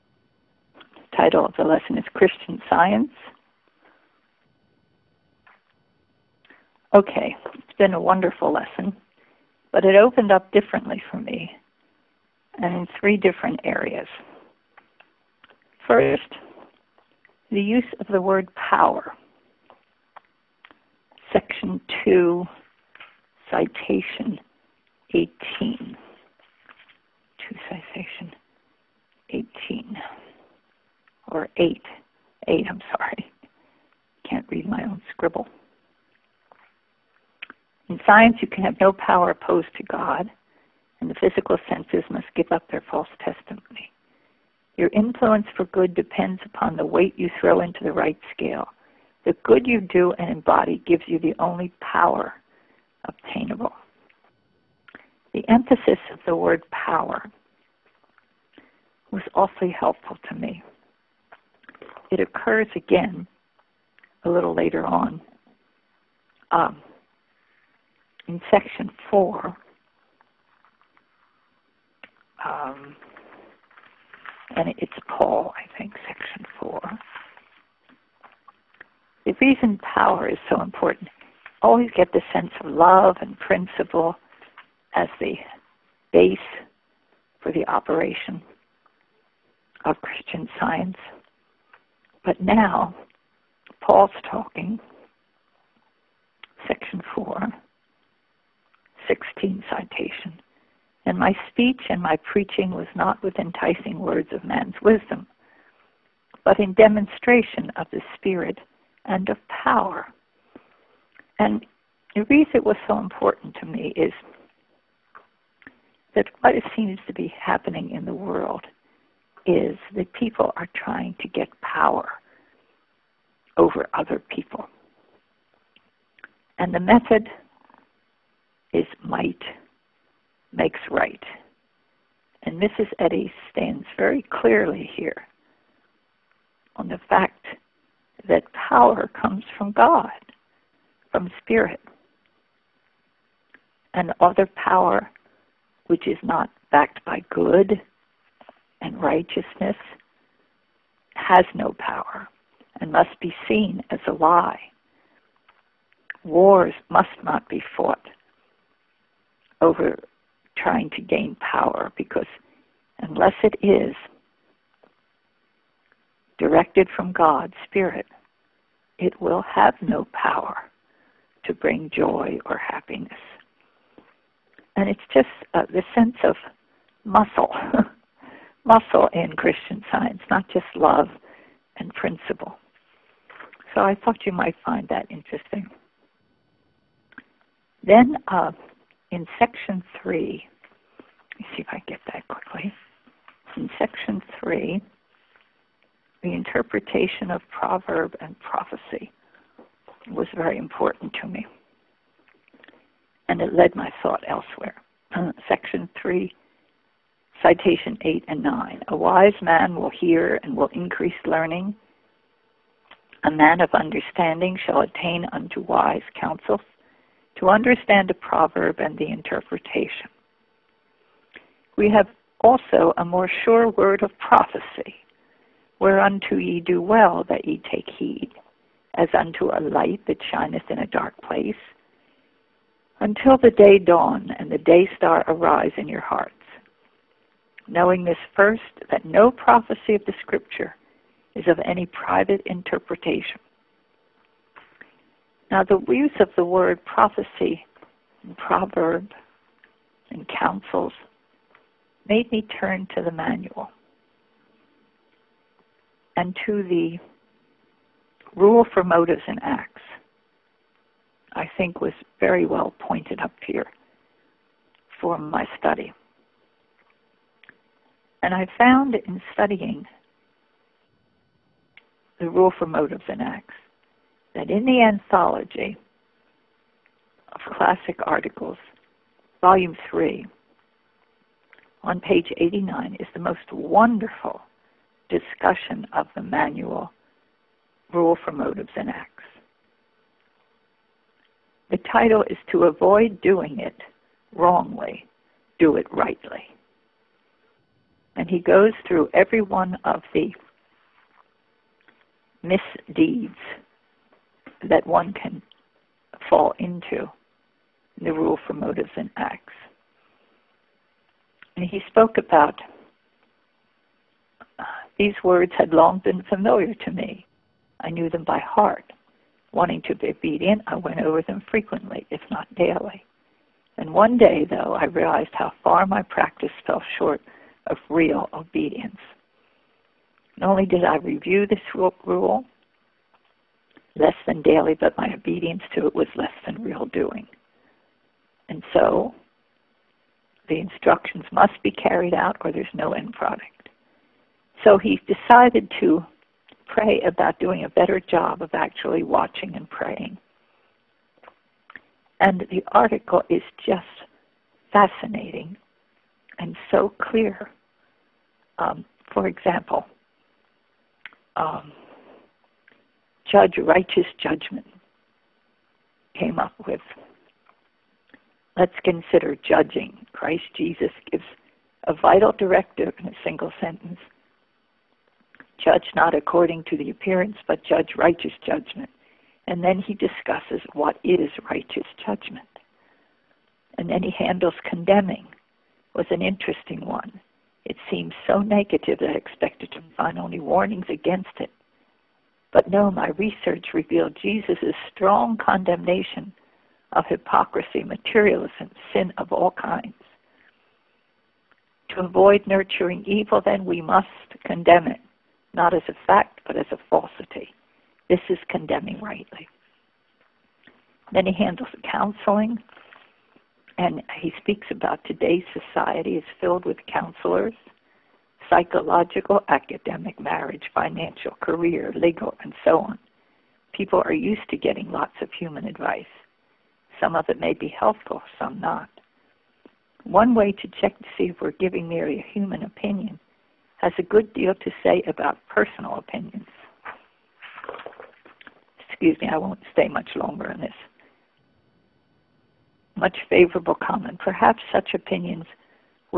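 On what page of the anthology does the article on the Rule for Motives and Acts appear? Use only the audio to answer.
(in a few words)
89.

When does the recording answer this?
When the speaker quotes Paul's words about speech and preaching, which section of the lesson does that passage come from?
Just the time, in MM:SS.
01:36.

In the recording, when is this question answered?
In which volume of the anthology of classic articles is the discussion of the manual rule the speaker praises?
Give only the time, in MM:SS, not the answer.
04:39.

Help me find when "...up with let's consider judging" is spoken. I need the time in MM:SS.
06:06.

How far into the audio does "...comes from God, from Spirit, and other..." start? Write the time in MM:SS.
02:19.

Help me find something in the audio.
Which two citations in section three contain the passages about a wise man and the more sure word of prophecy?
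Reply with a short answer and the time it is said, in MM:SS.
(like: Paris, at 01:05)
8 and 9, at 03:27.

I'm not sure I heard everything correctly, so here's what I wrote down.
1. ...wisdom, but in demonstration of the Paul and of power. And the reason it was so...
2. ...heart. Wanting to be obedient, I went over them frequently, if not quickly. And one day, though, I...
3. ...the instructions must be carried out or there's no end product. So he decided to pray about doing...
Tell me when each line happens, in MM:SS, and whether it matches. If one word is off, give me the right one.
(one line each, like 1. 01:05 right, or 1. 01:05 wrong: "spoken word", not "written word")
1. 01:44 wrong: "Spirit", not "Paul"
2. 05:18 wrong: "daily", not "quickly"
3. 05:40 right.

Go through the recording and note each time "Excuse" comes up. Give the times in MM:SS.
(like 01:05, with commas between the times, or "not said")
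07:18.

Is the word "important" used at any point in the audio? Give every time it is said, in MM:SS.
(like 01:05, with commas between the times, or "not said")
01:20, 01:52, 03:20.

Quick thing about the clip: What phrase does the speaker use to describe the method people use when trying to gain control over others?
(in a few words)
might makes right.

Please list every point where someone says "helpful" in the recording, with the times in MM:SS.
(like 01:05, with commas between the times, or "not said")
00:59, 07:07.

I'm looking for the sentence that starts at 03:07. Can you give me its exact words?
Then uh, in section three, let me see if I get that quickly.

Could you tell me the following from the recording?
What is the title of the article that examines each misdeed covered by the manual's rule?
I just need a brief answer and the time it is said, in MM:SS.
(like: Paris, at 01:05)
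To Avoid Doing It Wrongly, Do It Rightly, at 04:52.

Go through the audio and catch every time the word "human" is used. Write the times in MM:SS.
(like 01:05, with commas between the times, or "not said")
07:05, 07:12.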